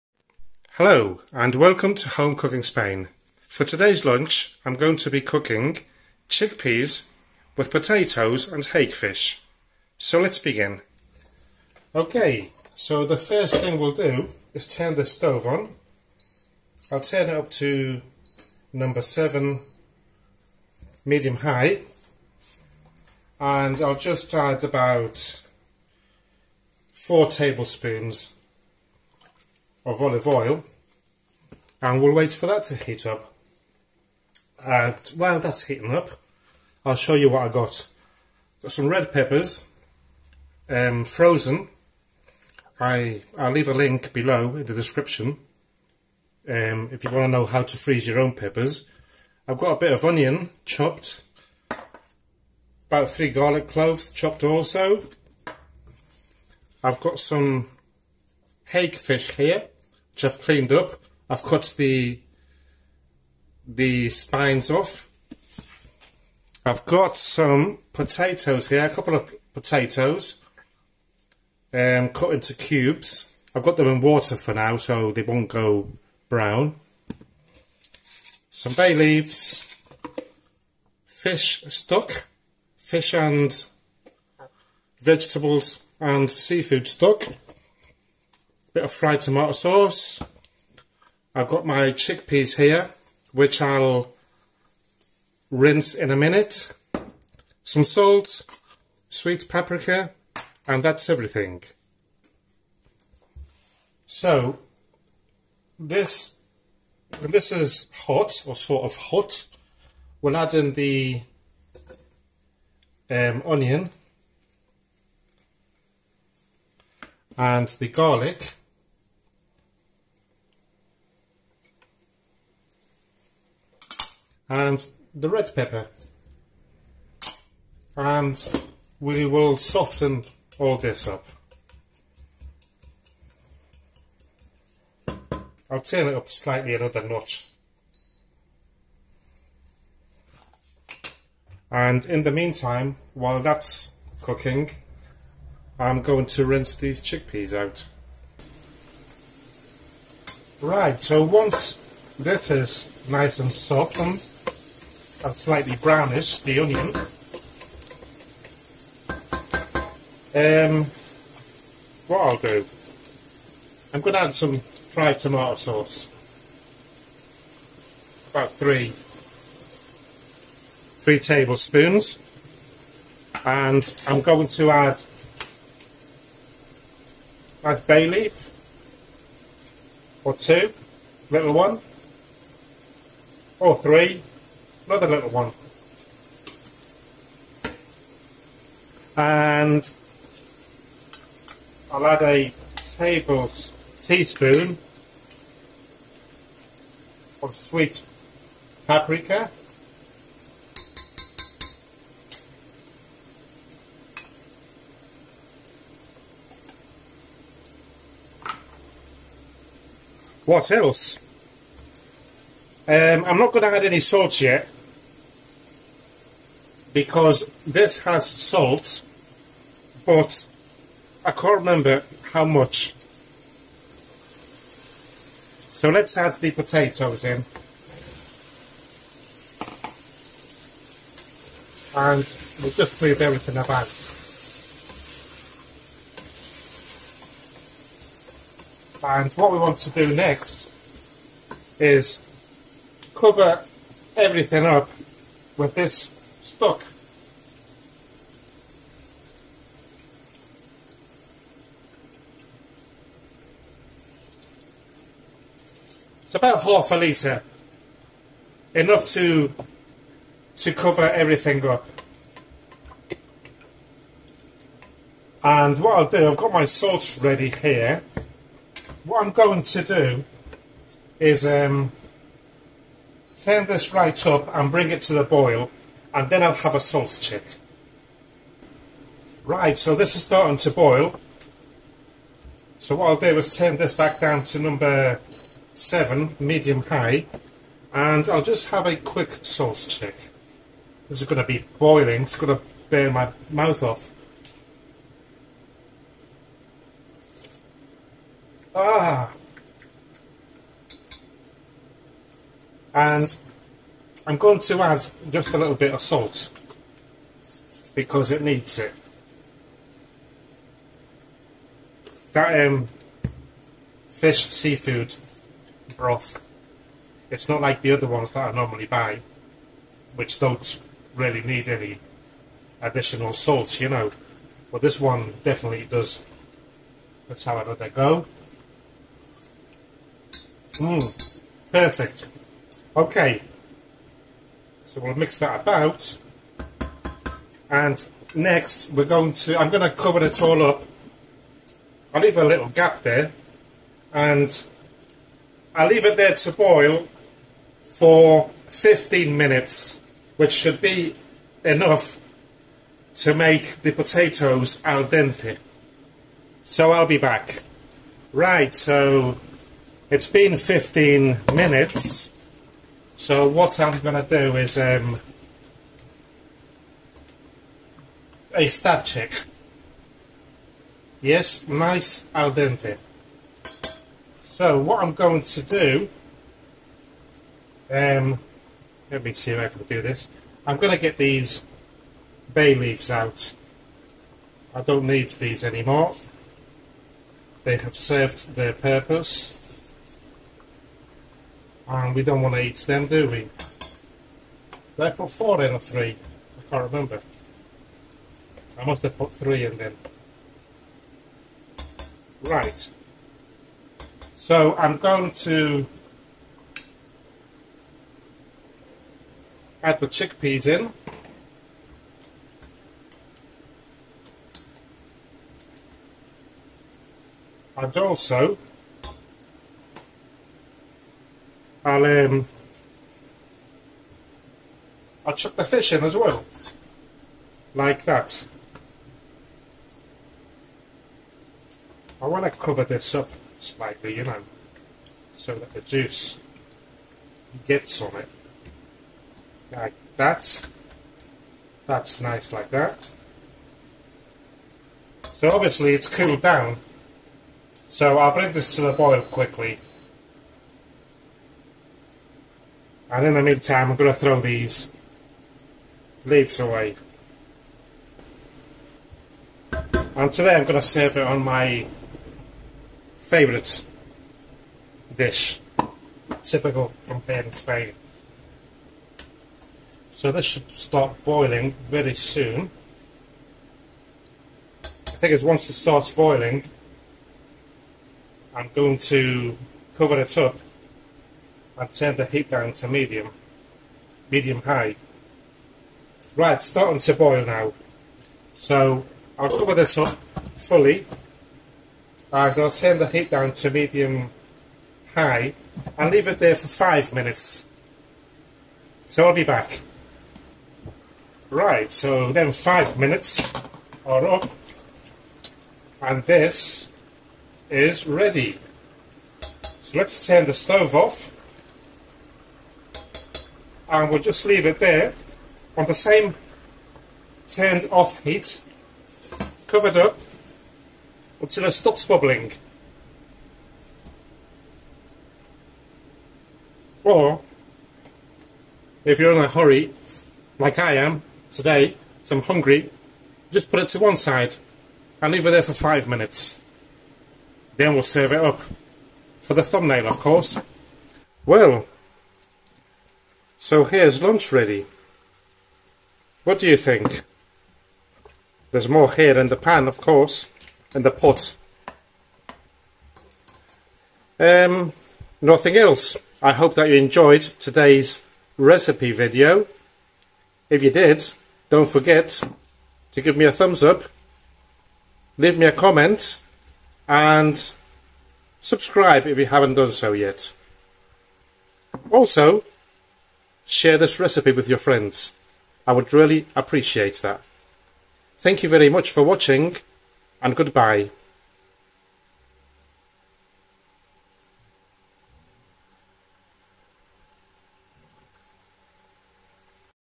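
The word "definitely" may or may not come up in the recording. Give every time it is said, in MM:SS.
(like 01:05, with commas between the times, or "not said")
05:25.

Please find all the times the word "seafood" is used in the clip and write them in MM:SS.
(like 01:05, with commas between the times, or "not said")
01:26, 05:14.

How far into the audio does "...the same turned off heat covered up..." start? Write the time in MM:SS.
08:35.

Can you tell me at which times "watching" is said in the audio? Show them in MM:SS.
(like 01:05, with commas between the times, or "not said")
09:39.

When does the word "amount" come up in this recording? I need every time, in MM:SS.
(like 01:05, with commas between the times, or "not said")
not said.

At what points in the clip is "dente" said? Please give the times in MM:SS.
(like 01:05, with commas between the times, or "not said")
05:55, 06:12.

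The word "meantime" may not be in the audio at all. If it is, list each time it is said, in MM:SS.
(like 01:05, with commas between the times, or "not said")
02:22, 07:33.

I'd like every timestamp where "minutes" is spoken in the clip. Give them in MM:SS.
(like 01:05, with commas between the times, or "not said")
01:36, 05:49, 06:01, 08:17, 08:22, 08:56.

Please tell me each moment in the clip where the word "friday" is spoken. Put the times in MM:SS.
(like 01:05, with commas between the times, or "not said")
not said.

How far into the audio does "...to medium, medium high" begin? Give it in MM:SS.
08:02.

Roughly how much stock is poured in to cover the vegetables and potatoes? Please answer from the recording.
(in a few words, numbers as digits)
half a litre.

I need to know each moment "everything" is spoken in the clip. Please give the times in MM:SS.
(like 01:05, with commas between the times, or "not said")
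01:41, 03:53, 04:04, 04:21.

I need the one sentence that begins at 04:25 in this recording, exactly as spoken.
And what I'll do, I've got my salts ready here.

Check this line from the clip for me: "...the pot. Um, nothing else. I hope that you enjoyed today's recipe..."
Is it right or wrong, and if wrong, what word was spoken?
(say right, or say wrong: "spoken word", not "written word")
right.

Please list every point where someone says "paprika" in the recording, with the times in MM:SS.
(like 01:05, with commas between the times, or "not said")
01:39, 03:18.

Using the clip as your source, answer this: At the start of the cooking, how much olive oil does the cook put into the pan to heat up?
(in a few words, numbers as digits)
4 tablespoons.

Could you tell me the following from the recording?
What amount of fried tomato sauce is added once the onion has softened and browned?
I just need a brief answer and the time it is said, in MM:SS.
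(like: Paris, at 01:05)
3 tablespoons, at 02:51.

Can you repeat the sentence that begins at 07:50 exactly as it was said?
So this should start boiling very soon.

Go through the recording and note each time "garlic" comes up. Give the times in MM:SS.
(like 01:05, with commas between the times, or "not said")
00:53, 01:57.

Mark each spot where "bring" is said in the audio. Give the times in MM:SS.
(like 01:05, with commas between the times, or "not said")
04:34, 07:28.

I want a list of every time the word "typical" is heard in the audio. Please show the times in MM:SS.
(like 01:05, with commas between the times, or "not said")
07:46.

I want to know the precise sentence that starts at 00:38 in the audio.
Got some red peppers, um, frozen.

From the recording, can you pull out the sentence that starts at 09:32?
Also, Share this recipe with your friends.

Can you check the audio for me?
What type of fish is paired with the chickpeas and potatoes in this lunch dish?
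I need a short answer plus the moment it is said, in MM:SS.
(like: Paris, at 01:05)
hake, at 00:58.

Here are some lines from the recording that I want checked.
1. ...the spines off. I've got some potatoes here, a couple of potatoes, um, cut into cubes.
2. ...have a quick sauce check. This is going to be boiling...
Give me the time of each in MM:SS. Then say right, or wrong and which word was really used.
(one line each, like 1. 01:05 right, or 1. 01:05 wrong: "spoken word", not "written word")
1. 01:03 right
2. 04:48 right.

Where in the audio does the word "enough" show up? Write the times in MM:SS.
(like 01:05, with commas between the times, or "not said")
04:18, 05:51.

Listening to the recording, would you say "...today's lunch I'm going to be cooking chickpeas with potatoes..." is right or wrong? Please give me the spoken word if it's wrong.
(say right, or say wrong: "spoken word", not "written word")
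right.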